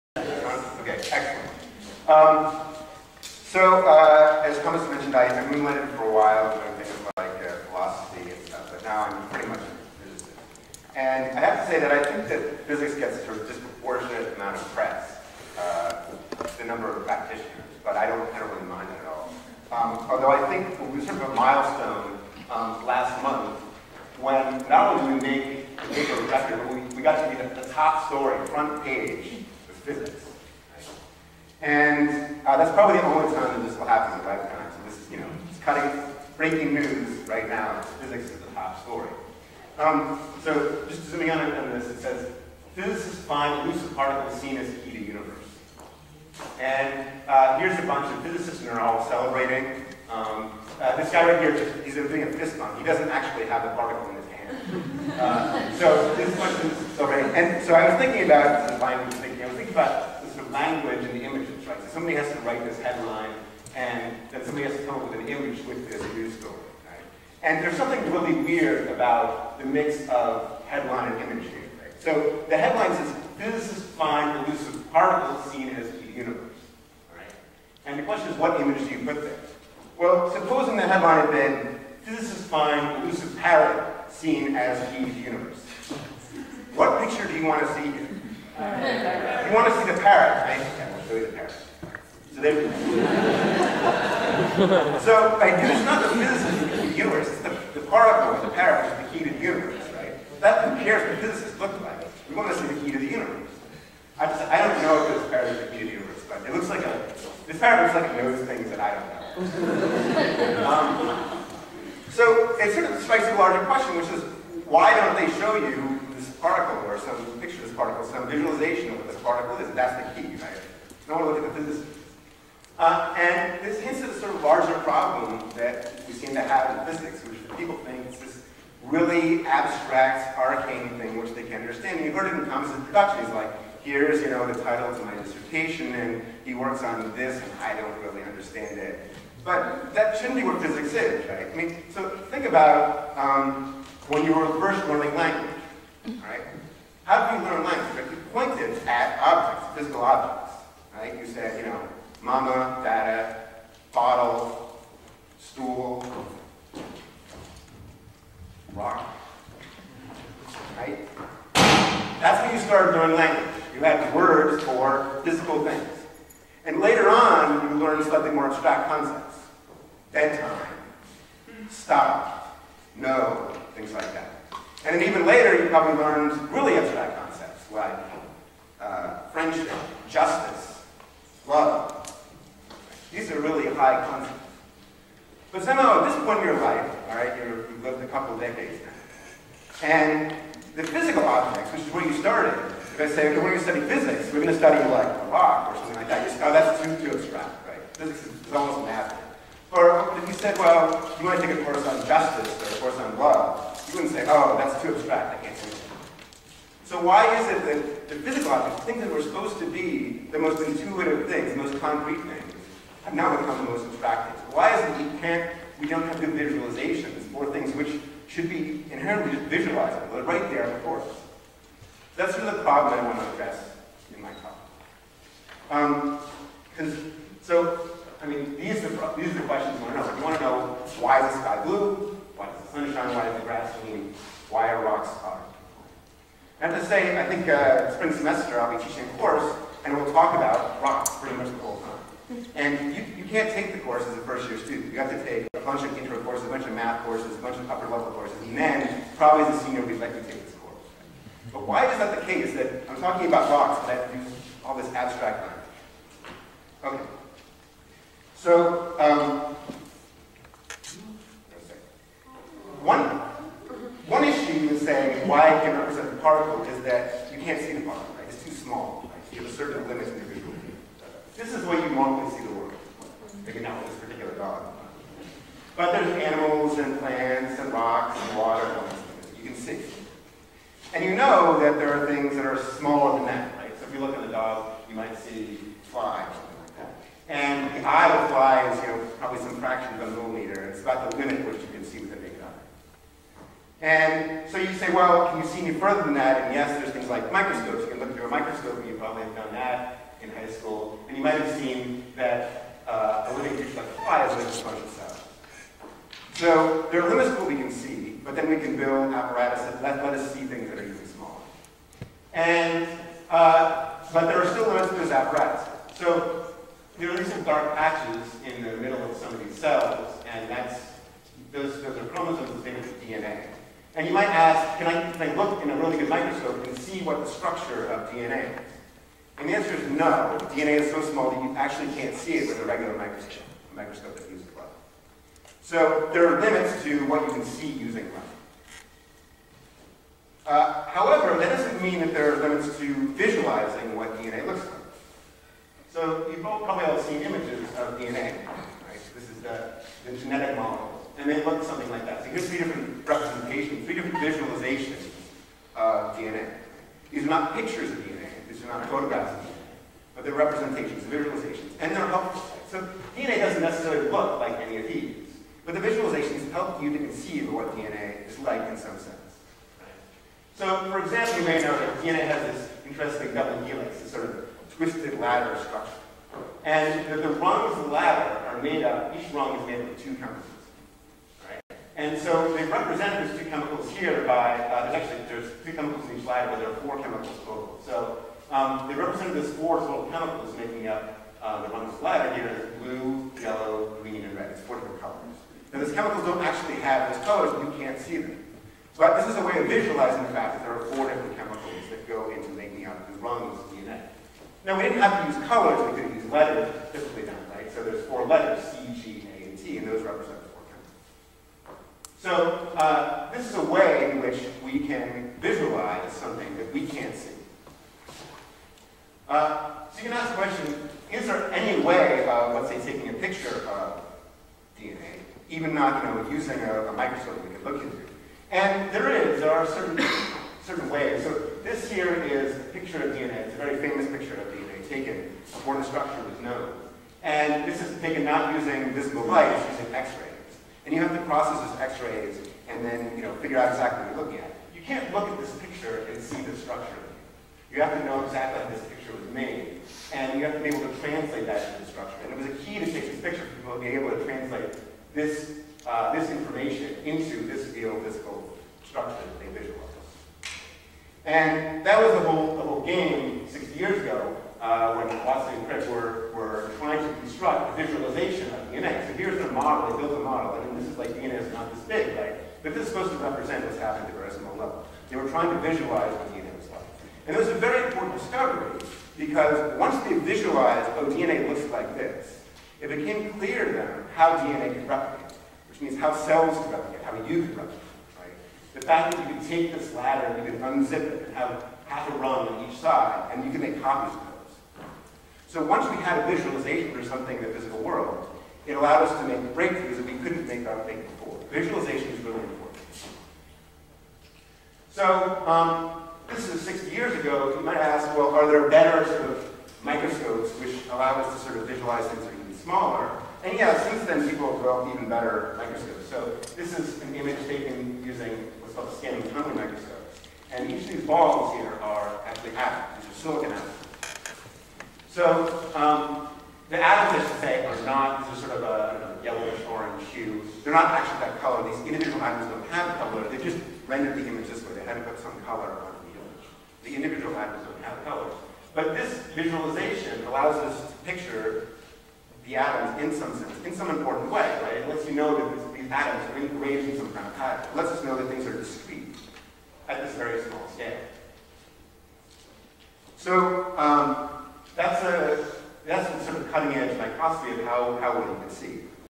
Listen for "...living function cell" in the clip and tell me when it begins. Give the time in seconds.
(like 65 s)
304 s.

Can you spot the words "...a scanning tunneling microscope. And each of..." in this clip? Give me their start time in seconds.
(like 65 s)
518 s.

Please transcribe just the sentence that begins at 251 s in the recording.
But why is that the case that I'm talking about rocks, but I have to use all this abstract language?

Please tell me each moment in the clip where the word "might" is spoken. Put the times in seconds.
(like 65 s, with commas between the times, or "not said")
284 s, 301 s, 324 s, 507 s.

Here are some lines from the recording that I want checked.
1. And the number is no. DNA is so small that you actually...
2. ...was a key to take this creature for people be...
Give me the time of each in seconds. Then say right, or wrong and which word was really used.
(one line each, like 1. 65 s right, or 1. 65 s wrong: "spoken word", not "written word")
1. 329 s wrong: "answer", not "number"
2. 452 s wrong: "picture", not "creature".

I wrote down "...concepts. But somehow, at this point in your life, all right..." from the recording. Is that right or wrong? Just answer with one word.
right.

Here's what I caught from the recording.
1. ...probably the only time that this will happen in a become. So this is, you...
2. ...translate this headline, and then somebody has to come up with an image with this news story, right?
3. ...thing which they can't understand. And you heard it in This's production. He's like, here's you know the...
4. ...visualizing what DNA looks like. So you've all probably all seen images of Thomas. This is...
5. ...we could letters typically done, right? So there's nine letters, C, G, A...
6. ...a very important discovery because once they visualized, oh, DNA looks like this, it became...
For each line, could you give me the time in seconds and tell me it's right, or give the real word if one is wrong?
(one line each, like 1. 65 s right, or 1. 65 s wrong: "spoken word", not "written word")
1. 32 s wrong: "lifetime", not "become"
2. 62 s wrong: "write", not "translate"
3. 130 s wrong: "Thomas", not "This"
4. 343 s wrong: "DNA", not "Thomas"
5. 405 s wrong: "four", not "nine"
6. 477 s right.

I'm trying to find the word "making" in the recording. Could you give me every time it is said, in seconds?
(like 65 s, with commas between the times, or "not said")
390 s, 402 s.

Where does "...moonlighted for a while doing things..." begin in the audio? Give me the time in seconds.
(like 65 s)
5 s.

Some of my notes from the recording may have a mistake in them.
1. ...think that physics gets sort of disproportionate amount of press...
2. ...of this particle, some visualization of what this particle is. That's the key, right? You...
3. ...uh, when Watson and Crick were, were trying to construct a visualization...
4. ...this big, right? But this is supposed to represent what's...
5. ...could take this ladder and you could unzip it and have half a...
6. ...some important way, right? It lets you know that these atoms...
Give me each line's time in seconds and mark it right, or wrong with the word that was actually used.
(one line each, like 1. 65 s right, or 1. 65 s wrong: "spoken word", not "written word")
1. 12 s right
2. 117 s right
3. 464 s right
4. 471 s right
5. 489 s right
6. 543 s right.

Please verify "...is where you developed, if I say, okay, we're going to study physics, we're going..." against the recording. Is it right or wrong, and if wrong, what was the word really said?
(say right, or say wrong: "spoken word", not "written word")
wrong: "started", not "developed".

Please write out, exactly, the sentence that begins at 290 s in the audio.
It's about the limit which you can see with a eye.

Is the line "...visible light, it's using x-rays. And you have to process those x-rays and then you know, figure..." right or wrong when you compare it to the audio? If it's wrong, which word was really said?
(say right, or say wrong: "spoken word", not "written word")
right.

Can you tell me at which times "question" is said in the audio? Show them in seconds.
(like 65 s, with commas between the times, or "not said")
78 s, 113 s, 229 s, 420 s.